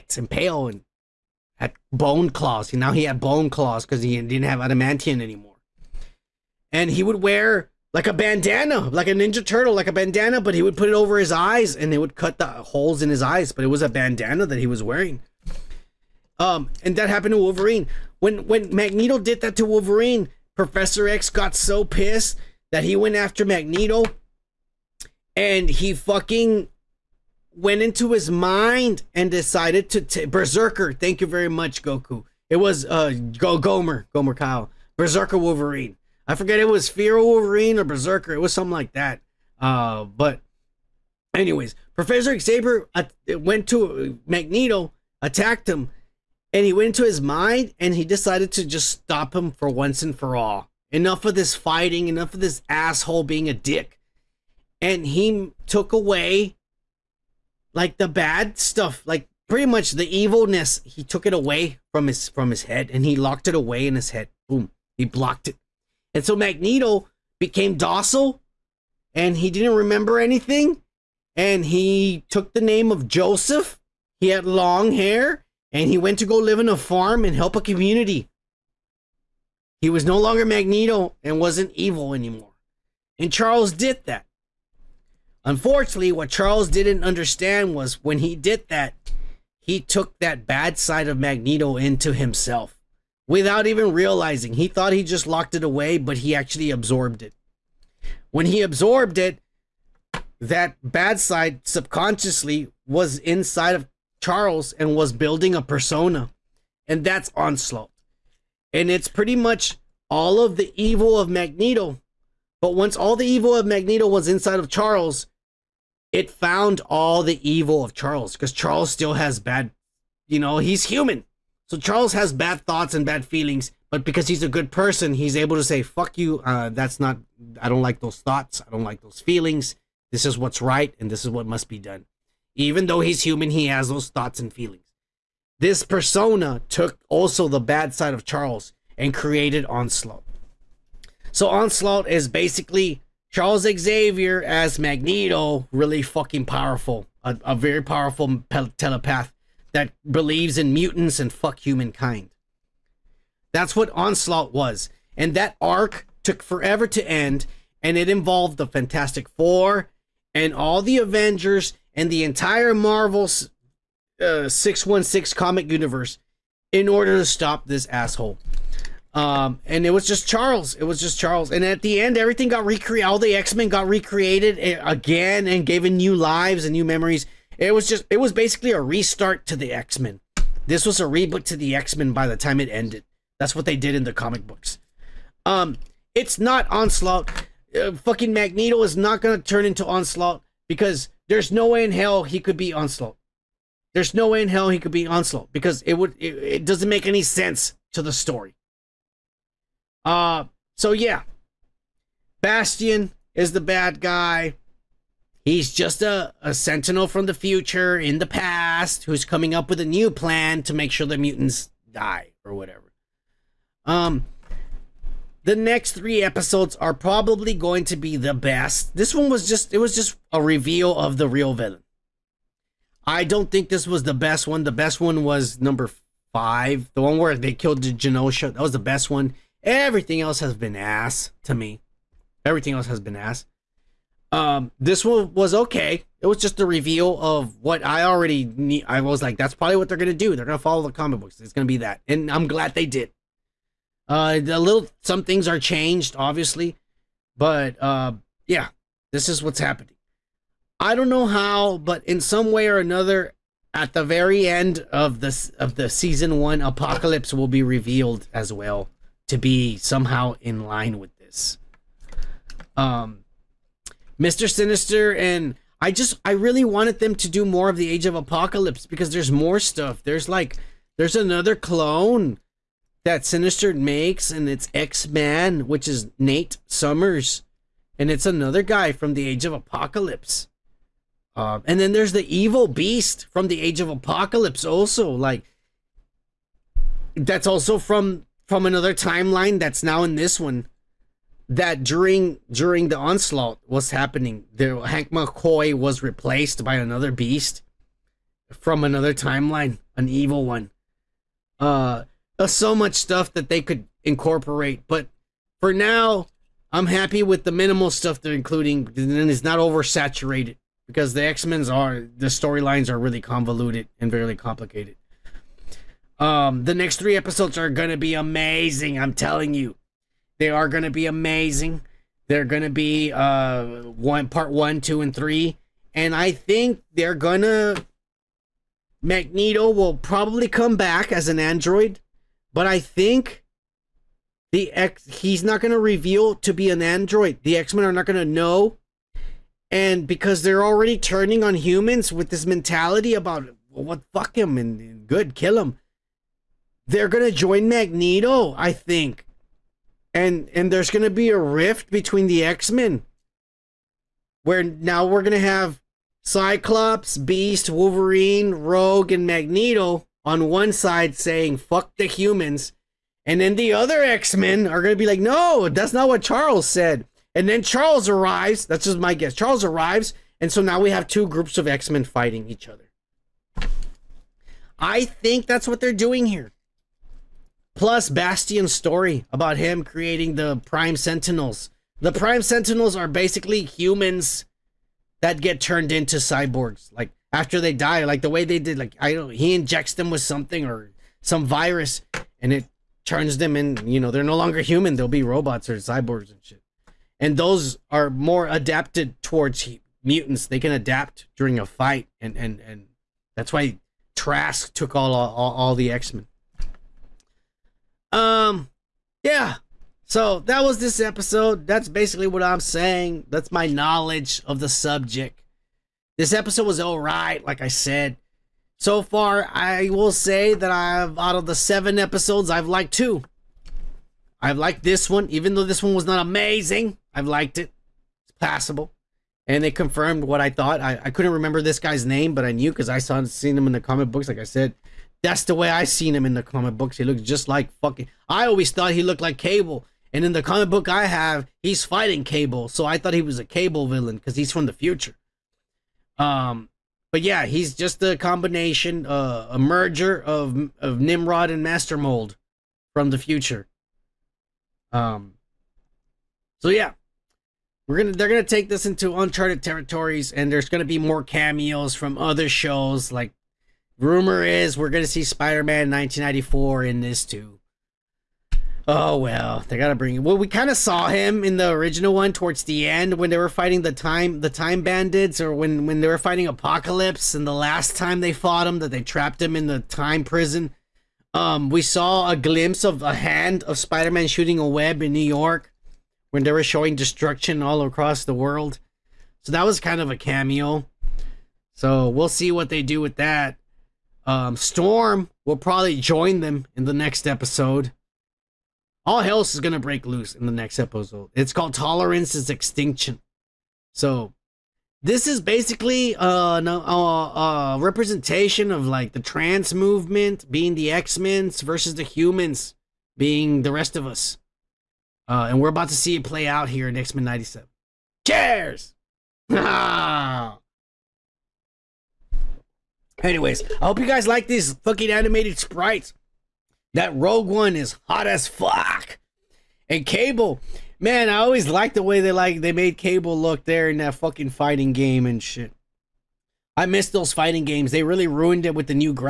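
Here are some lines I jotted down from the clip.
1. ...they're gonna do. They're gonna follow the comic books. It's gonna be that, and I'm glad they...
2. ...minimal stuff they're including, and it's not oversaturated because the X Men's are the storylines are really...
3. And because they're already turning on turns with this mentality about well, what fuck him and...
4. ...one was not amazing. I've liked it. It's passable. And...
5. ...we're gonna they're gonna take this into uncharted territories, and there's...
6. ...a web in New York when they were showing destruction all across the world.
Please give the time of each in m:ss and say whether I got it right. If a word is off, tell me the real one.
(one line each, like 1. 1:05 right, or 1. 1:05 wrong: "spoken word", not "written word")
1. 3:59 right
2. 5:07 right
3. 5:39 wrong: "humans", not "turns"
4. 7:05 right
5. 7:37 right
6. 8:04 right.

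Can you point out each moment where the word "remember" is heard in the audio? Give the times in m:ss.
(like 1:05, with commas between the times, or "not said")
1:09, 7:11.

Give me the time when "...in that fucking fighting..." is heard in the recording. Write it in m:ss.
8:53.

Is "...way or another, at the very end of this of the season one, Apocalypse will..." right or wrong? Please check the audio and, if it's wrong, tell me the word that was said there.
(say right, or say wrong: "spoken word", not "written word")
right.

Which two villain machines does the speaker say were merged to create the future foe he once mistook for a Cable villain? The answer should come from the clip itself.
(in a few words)
Nimrod and Master Mold.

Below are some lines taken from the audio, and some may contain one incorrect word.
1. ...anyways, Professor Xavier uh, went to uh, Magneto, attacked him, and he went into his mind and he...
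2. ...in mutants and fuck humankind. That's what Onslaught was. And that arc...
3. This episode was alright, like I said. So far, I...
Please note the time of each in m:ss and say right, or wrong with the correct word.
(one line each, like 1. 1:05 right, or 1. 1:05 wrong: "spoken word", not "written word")
1. 0:41 right
2. 2:30 right
3. 6:56 right.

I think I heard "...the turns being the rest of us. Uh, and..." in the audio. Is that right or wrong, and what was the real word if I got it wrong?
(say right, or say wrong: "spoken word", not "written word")
wrong: "humans", not "turns".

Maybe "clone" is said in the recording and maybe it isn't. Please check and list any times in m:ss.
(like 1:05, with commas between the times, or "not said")
4:31.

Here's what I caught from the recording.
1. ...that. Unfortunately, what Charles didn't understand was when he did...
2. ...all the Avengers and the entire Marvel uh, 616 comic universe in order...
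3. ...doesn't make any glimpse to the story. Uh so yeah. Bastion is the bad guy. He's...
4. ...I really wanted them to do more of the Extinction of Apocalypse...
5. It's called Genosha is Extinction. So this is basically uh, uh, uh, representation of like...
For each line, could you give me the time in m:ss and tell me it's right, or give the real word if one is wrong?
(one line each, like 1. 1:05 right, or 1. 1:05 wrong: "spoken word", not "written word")
1. 1:24 right
2. 2:40 right
3. 3:16 wrong: "sense", not "glimpse"
4. 4:26 wrong: "Age", not "Extinction"
5. 8:21 wrong: "Tolerance", not "Genosha".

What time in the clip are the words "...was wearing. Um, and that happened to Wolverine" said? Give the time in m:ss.
0:14.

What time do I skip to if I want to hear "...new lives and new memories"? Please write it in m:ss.
2:55.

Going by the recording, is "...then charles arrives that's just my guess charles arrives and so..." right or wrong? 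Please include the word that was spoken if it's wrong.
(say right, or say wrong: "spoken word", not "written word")
right.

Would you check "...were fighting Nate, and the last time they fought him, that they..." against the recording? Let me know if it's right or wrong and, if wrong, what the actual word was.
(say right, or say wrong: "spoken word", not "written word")
wrong: "Apocalypse", not "Nate".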